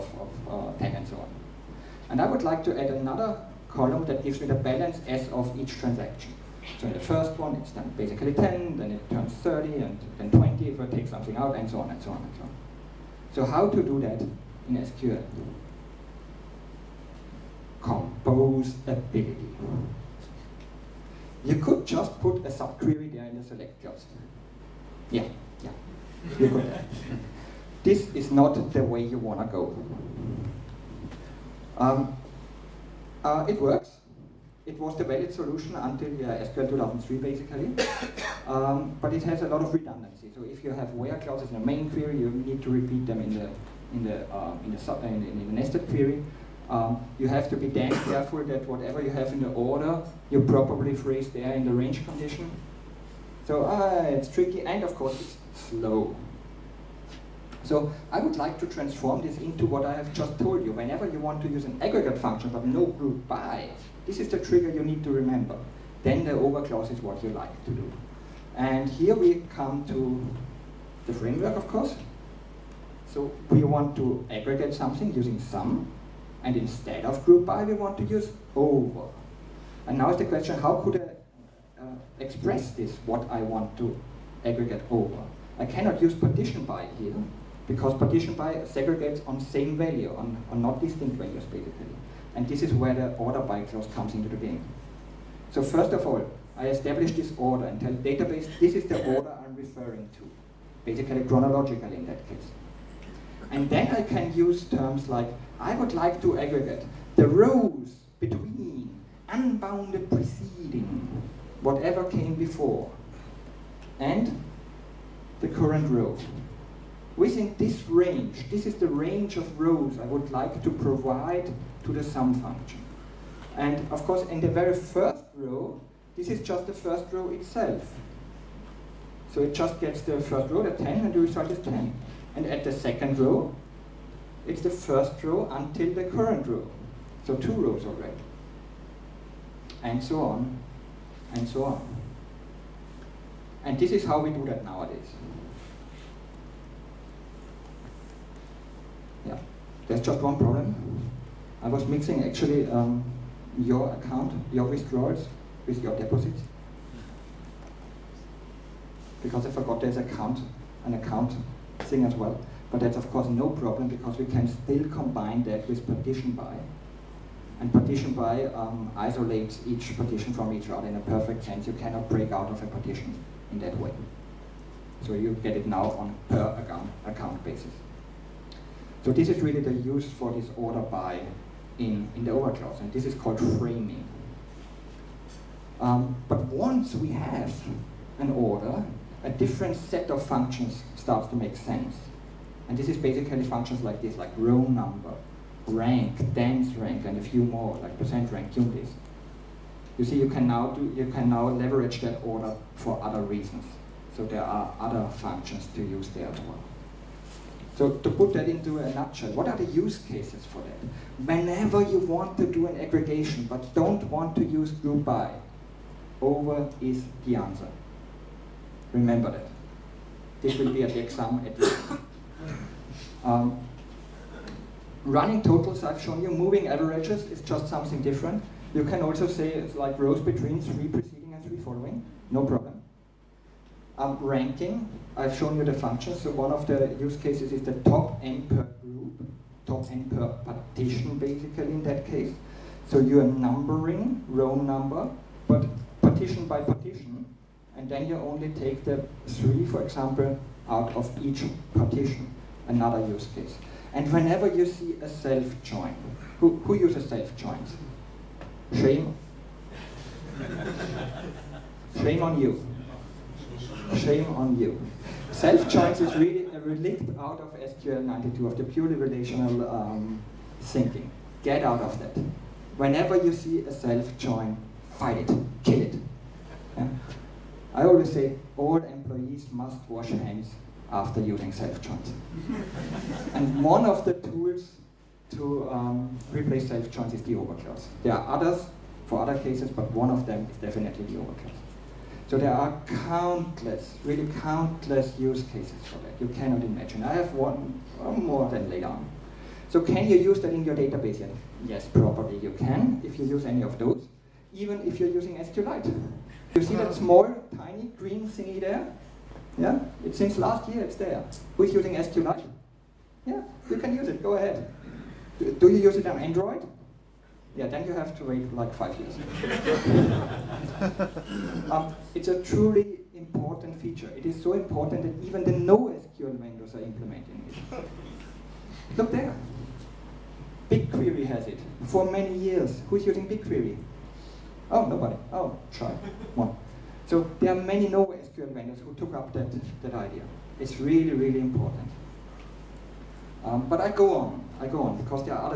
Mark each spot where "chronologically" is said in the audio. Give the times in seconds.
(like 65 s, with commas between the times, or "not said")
101 s.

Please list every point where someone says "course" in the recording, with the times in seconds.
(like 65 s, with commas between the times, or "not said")
54 s, 71 s, 124 s, 163 s.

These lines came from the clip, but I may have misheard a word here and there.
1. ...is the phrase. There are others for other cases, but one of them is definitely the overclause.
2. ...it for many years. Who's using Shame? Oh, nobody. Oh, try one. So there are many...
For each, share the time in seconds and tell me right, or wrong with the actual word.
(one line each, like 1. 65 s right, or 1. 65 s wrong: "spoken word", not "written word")
1. 287 s wrong: "overclause", not "phrase"
2. 331 s wrong: "BigQuery", not "Shame".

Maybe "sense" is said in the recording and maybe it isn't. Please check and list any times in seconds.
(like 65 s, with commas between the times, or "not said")
171 s, 191 s.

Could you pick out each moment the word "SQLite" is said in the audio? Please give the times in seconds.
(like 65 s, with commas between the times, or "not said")
305 s, 311 s.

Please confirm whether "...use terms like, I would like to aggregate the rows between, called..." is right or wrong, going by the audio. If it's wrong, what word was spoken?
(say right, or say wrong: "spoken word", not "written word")
wrong: "unbounded", not "called".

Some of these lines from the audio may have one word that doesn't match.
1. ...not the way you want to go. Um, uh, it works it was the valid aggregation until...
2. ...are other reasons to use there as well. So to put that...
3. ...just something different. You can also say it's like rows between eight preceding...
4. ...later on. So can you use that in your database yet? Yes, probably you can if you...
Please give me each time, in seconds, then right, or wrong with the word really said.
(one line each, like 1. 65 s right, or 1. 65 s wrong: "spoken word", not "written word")
1. 28 s wrong: "solution", not "aggregation"
2. 204 s wrong: "functions", not "reasons"
3. 227 s wrong: "three", not "eight"
4. 298 s right.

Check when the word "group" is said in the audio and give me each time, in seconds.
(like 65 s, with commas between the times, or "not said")
62 s, 77 s, 214 s, 238 s.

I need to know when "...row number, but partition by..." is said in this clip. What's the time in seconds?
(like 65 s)
244 s.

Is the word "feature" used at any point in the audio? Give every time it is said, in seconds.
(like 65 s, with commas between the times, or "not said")
323 s.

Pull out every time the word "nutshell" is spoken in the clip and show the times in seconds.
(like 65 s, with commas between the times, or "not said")
208 s.